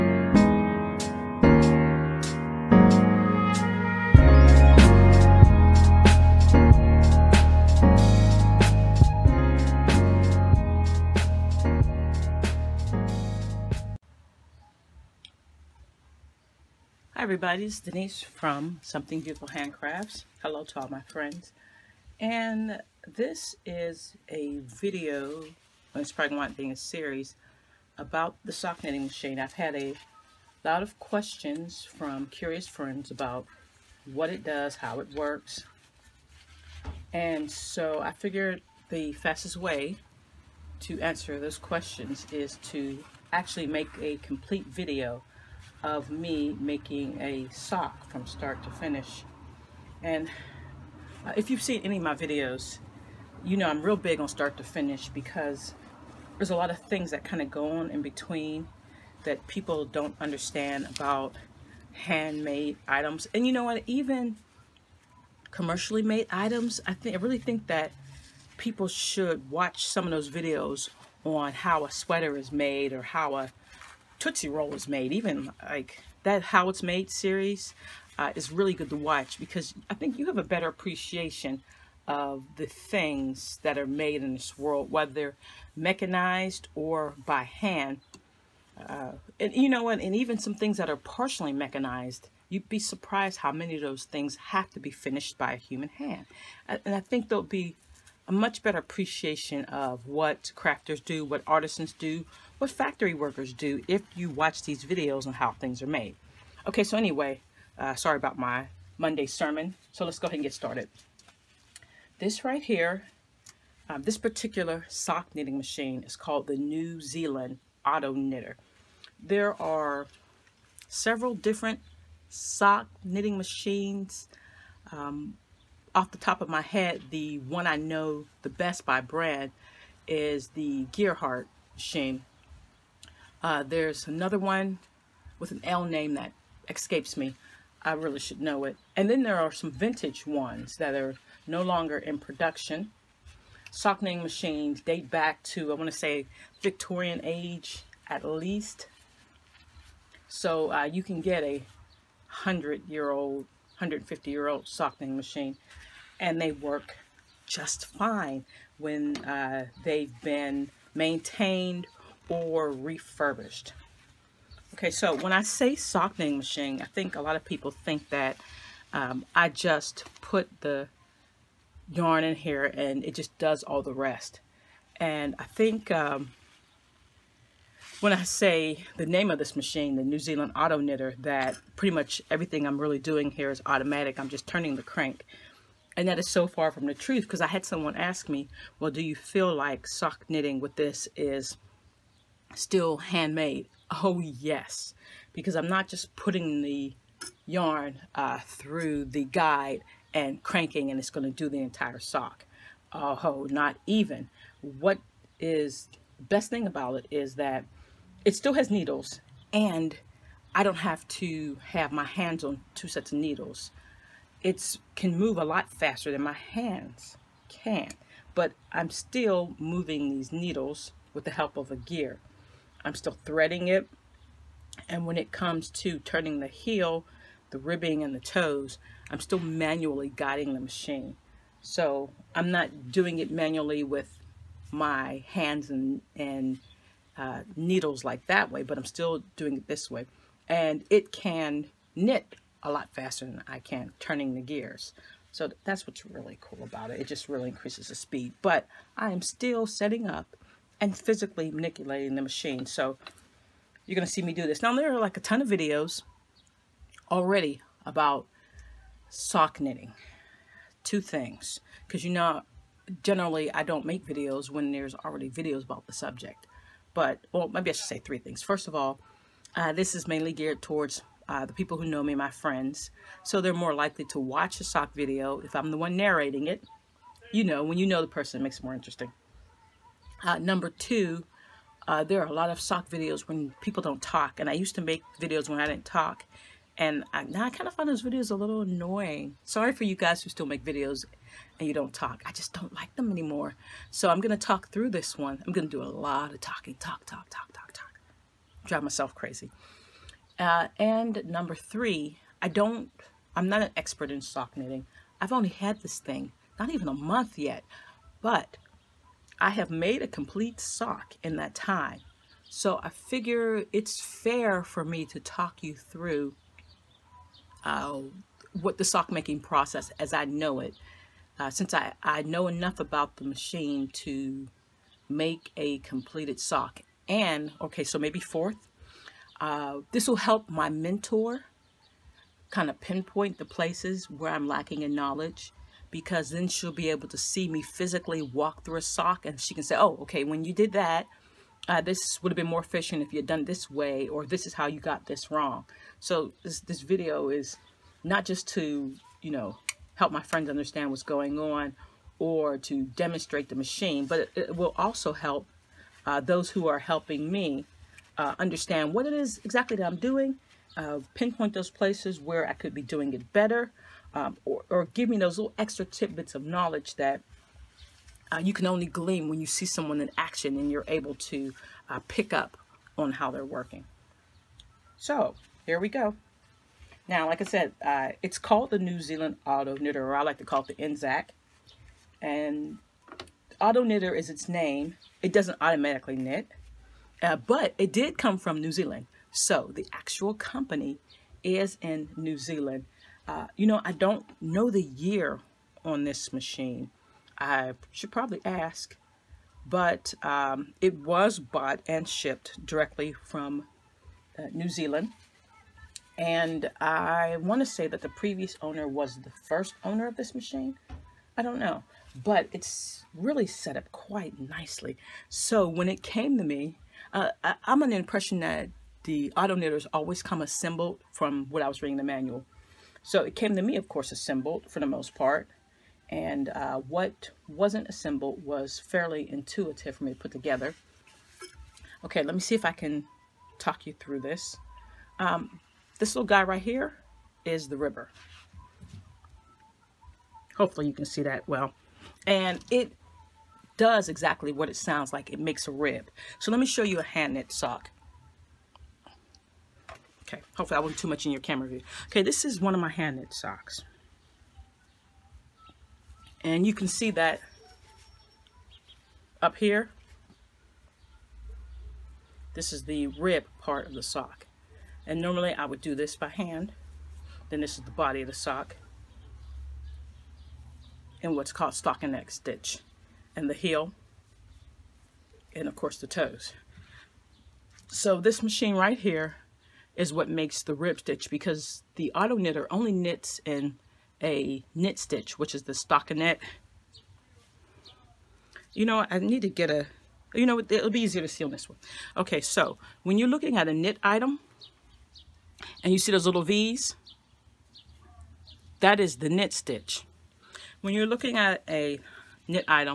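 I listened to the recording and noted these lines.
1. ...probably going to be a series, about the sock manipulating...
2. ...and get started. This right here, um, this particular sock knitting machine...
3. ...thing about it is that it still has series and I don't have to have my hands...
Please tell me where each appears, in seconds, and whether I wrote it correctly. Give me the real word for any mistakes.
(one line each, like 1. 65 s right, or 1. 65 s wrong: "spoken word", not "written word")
1. 26 s wrong: "knitting", not "manipulating"
2. 110 s right
3. 206 s wrong: "needles", not "series".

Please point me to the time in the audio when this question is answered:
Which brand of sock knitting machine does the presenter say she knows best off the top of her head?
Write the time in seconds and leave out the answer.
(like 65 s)
130 s.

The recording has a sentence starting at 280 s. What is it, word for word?
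Uh, number two, uh, there are a lot of sock videos when people don't talk.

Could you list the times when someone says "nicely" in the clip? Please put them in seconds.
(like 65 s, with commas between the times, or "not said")
414 s.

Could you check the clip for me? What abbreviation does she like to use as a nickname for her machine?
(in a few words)
NZAK.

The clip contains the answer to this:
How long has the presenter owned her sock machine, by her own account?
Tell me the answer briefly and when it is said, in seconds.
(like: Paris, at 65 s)
not even a month, at 306 s.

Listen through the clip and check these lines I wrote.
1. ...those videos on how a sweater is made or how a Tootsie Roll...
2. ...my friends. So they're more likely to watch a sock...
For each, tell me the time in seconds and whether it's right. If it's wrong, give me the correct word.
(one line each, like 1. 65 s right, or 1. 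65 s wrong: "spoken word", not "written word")
1. 70 s right
2. 272 s right.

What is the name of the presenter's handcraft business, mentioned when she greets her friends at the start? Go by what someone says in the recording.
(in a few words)
Something Beautiful Handcrafts.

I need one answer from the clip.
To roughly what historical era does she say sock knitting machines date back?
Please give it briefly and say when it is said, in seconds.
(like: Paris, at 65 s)
Victorian age, at 146 s.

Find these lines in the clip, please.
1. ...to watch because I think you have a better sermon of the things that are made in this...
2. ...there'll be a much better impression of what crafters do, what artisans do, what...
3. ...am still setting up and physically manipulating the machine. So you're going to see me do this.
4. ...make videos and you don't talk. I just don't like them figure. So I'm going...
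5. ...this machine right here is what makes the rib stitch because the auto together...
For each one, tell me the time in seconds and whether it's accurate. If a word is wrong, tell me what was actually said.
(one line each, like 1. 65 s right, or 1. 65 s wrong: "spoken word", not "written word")
1. 78 s wrong: "appreciation", not "sermon"
2. 97 s wrong: "appreciation", not "impression"
3. 249 s right
4. 290 s wrong: "anymore", not "figure"
5. 478 s wrong: "knitter", not "together".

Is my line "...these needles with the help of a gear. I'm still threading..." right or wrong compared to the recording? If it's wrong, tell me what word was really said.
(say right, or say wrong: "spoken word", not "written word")
right.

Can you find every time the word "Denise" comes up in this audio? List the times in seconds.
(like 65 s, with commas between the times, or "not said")
17 s.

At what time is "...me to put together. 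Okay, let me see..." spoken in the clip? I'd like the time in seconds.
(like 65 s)
430 s.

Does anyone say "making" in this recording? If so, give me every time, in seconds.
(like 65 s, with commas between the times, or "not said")
46 s, 319 s.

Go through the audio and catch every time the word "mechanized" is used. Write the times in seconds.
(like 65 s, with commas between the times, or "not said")
85 s, 91 s.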